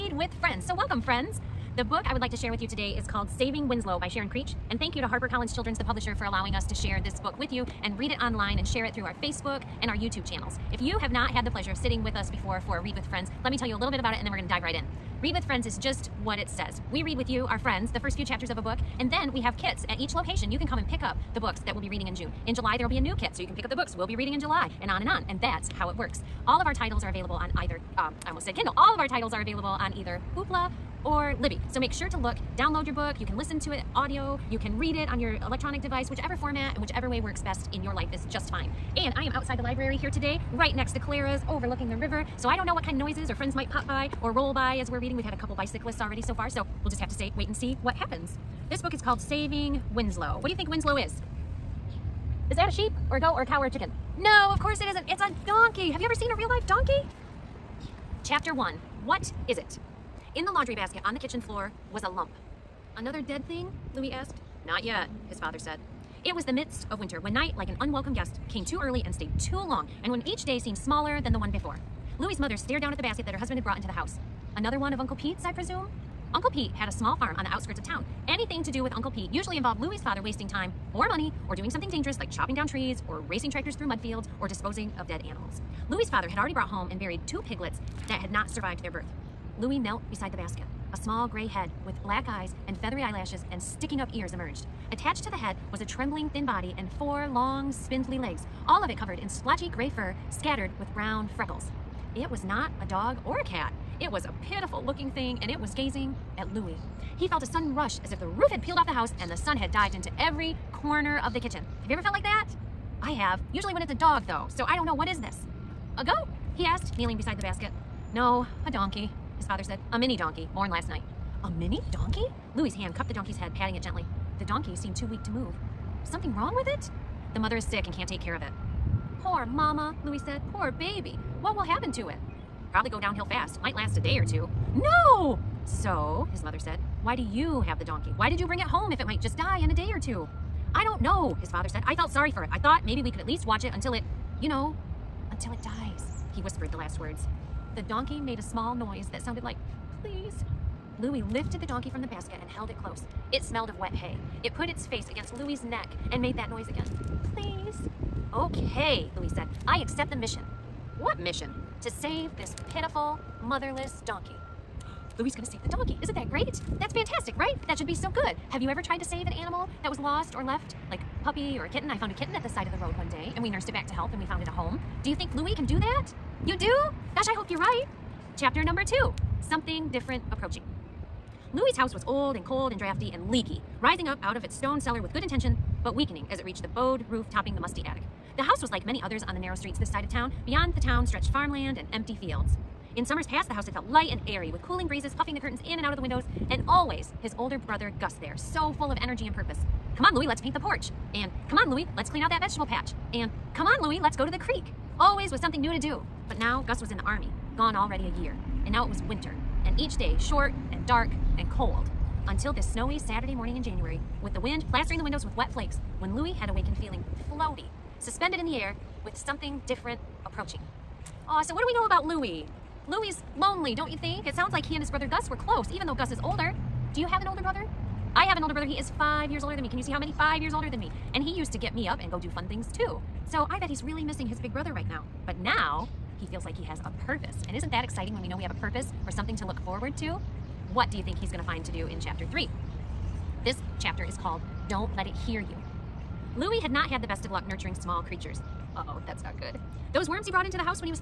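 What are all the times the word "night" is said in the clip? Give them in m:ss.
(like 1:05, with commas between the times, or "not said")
1:07, 2:00.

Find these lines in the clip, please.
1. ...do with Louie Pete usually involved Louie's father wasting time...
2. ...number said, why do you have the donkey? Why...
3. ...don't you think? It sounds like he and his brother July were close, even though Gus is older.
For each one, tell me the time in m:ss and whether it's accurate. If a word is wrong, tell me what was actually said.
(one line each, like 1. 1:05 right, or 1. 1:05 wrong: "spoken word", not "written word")
1. 1:18 wrong: "Uncle", not "Louie"
2. 2:16 wrong: "mother", not "number"
3. 3:43 wrong: "Gus", not "July".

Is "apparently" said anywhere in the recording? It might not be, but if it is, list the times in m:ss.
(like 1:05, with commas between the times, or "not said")
not said.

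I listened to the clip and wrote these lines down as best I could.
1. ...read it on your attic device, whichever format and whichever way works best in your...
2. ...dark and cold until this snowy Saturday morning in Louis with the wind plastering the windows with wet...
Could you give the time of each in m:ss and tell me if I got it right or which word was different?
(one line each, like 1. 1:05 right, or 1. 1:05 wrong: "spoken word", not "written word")
1. 0:34 wrong: "electronic", not "attic"
2. 3:30 wrong: "January", not "Louis".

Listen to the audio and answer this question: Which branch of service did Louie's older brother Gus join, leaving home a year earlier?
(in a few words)
the army.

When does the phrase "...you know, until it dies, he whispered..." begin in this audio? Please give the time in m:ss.
2:24.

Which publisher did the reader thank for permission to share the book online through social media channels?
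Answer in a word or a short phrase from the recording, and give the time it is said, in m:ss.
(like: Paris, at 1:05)
HarperCollins Children's, at 0:05.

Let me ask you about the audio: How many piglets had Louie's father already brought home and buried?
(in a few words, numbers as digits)
2.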